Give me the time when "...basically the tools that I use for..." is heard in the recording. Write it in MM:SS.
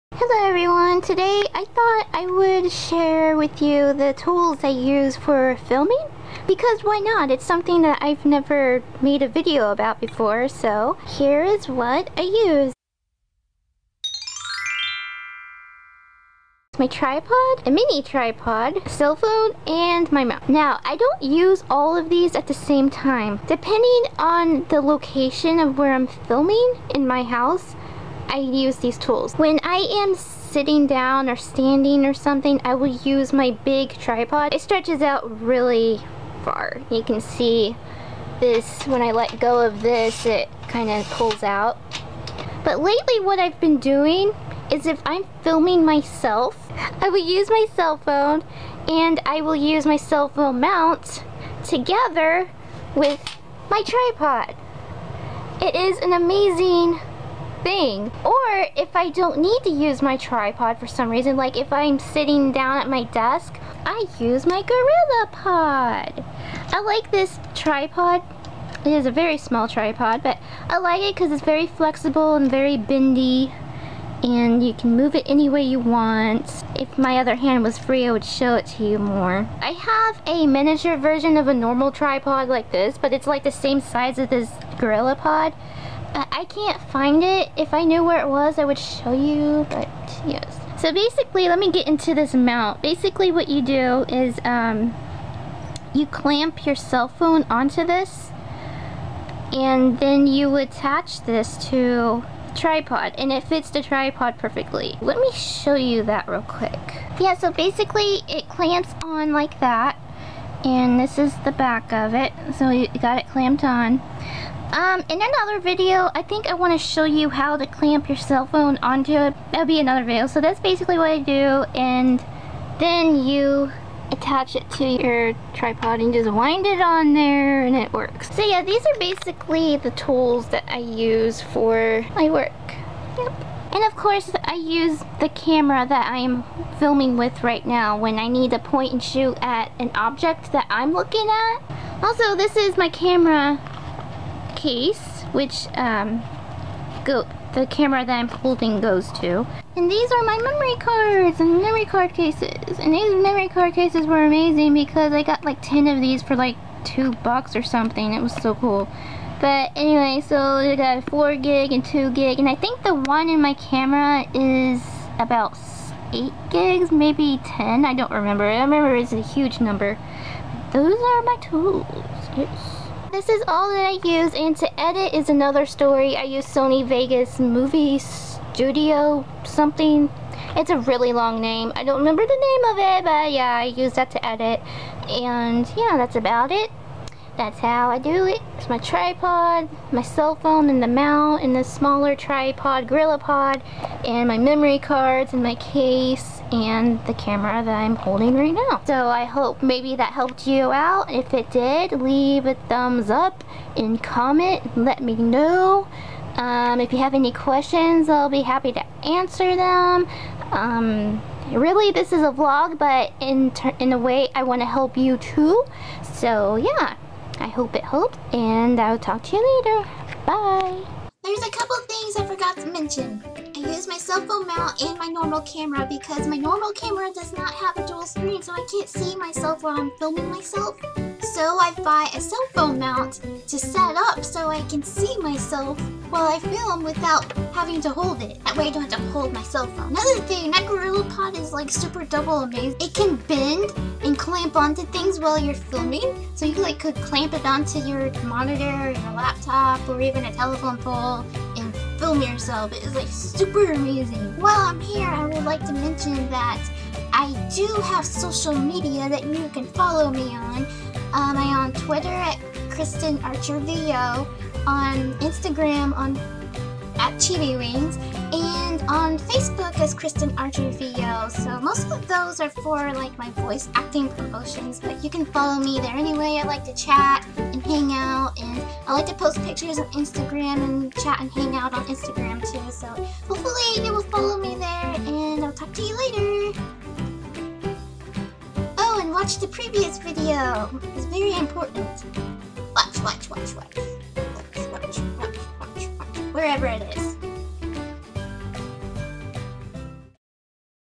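02:08.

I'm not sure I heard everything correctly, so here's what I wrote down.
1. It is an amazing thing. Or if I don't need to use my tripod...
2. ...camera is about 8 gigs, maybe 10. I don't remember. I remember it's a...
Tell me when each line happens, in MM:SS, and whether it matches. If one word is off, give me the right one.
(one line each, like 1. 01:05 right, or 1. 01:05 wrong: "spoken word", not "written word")
1. 00:55 right
2. 02:43 right.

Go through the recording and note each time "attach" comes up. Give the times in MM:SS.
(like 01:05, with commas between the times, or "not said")
01:40, 02:04.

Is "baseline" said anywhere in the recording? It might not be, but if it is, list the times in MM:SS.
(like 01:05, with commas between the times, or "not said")
not said.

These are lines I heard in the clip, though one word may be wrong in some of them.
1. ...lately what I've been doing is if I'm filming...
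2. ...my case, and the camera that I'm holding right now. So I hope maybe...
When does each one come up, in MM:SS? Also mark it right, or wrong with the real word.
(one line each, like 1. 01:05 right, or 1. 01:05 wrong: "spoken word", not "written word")
1. 00:42 right
2. 03:15 right.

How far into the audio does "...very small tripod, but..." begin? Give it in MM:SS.
01:09.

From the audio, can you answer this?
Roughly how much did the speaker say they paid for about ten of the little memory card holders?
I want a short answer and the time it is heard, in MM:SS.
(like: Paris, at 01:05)
2 bucks, at 02:36.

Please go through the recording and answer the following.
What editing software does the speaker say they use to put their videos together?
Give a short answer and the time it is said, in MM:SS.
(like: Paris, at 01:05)
Sony Vegas Movie Studio, at 02:56.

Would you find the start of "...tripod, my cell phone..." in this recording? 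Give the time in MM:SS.
03:08.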